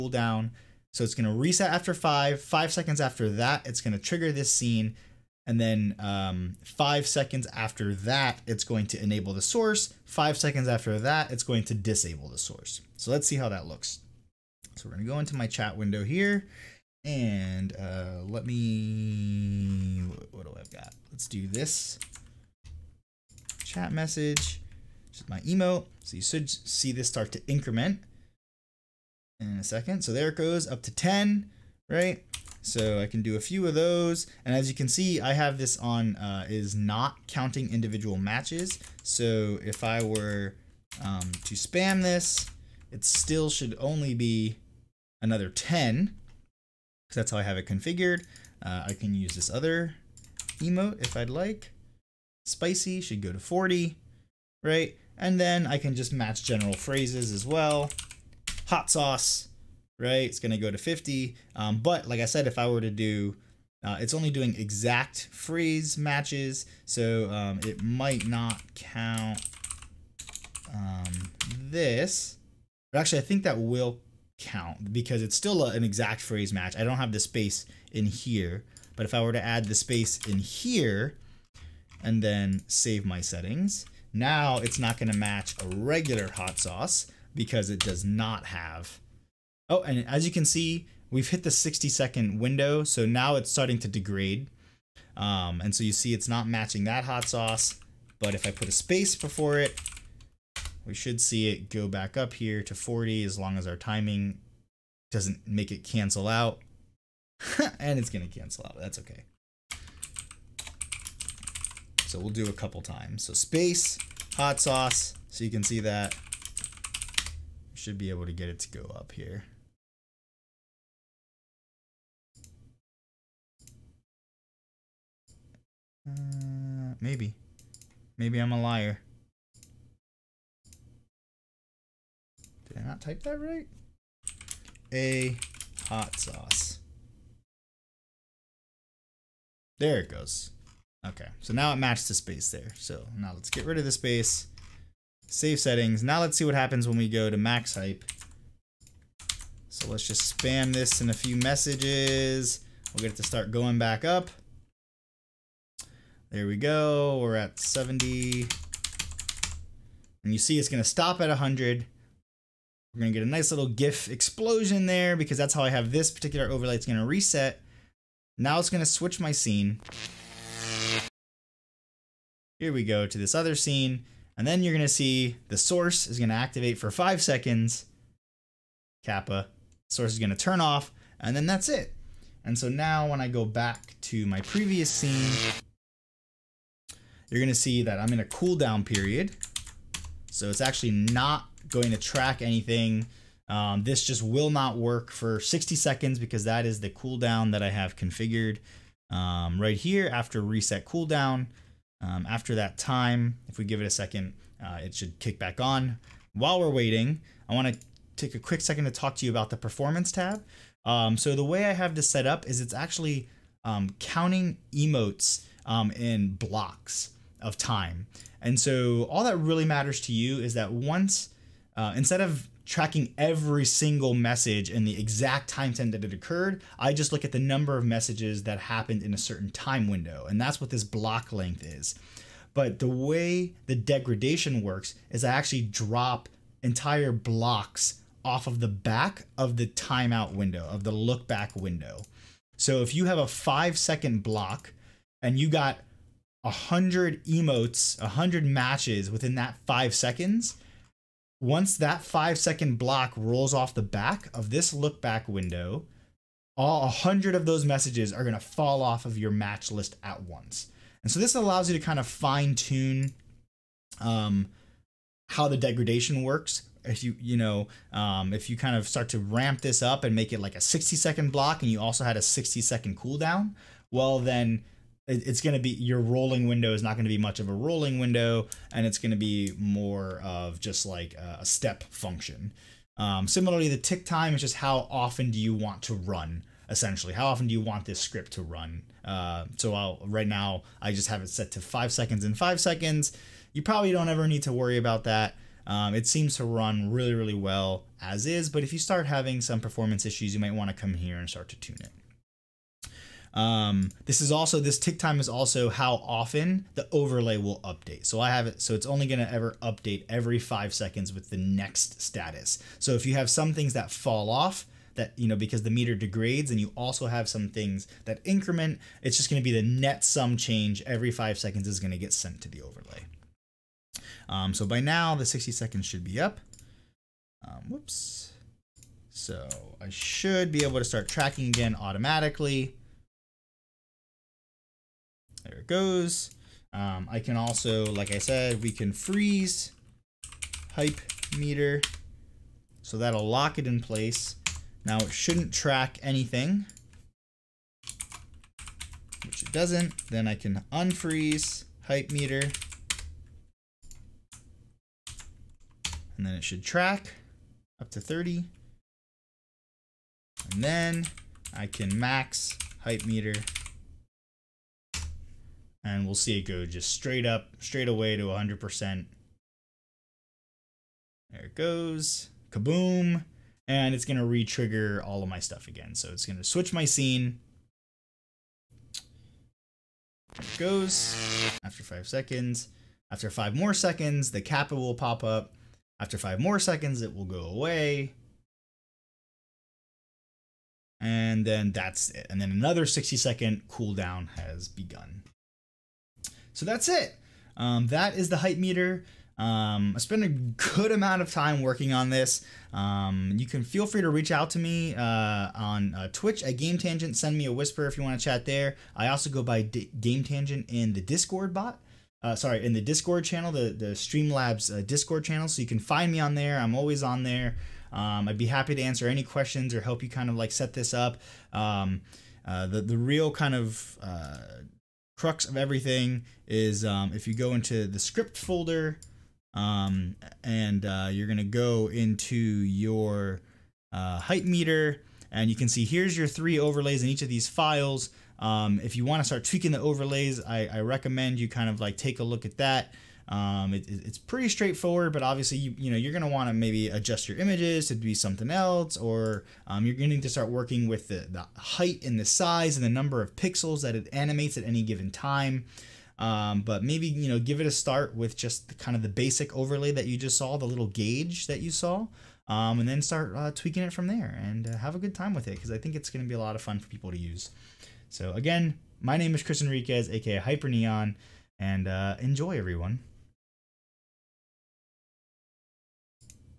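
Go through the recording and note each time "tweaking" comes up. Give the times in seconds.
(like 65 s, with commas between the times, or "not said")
439 s, 463 s.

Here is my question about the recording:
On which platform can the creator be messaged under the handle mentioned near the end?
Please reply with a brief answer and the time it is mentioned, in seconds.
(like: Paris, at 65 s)
Twitch, at 406 s.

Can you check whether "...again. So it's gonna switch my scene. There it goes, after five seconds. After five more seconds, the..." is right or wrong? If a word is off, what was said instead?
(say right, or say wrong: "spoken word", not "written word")
right.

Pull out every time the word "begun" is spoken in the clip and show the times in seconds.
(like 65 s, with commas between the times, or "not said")
394 s.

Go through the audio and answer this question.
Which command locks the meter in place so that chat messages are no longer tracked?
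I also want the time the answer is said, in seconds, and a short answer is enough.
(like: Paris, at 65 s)
freeze hype meter, at 338 s.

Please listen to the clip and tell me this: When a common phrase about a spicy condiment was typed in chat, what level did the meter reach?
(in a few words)
50.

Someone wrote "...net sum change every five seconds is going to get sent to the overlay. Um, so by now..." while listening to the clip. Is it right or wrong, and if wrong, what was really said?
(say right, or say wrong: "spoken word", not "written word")
right.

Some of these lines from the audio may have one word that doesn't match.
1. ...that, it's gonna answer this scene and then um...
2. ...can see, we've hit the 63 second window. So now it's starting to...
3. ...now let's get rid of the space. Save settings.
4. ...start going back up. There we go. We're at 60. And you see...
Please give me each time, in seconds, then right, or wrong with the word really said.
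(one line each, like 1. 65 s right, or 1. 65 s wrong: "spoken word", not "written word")
1. 3 s wrong: "trigger", not "answer"
2. 90 s wrong: "60", not "63"
3. 143 s right
4. 153 s wrong: "70", not "60".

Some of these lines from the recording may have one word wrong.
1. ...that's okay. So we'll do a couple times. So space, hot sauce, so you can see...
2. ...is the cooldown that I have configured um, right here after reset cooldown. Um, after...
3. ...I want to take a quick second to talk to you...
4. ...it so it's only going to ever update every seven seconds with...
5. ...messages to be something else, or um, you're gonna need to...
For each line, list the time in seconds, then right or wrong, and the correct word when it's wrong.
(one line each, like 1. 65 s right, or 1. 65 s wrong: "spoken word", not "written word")
1. 108 s right
2. 196 s right
3. 207 s right
4. 308 s wrong: "five", not "seven"
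5. 447 s wrong: "images", not "messages".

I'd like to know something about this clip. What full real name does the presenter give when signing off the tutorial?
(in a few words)
Chris Enriquez.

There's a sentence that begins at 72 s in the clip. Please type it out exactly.
But actually, I think that will count because it's still a, an exact phrase match.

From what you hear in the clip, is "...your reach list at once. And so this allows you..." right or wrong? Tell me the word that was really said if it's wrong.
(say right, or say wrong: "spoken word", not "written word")
wrong: "match", not "reach".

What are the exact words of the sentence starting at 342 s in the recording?
So that'll lock it in place.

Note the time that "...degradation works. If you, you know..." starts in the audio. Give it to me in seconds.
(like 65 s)
265 s.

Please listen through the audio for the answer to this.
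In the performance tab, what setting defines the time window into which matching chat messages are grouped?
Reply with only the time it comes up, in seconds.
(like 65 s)
230 s.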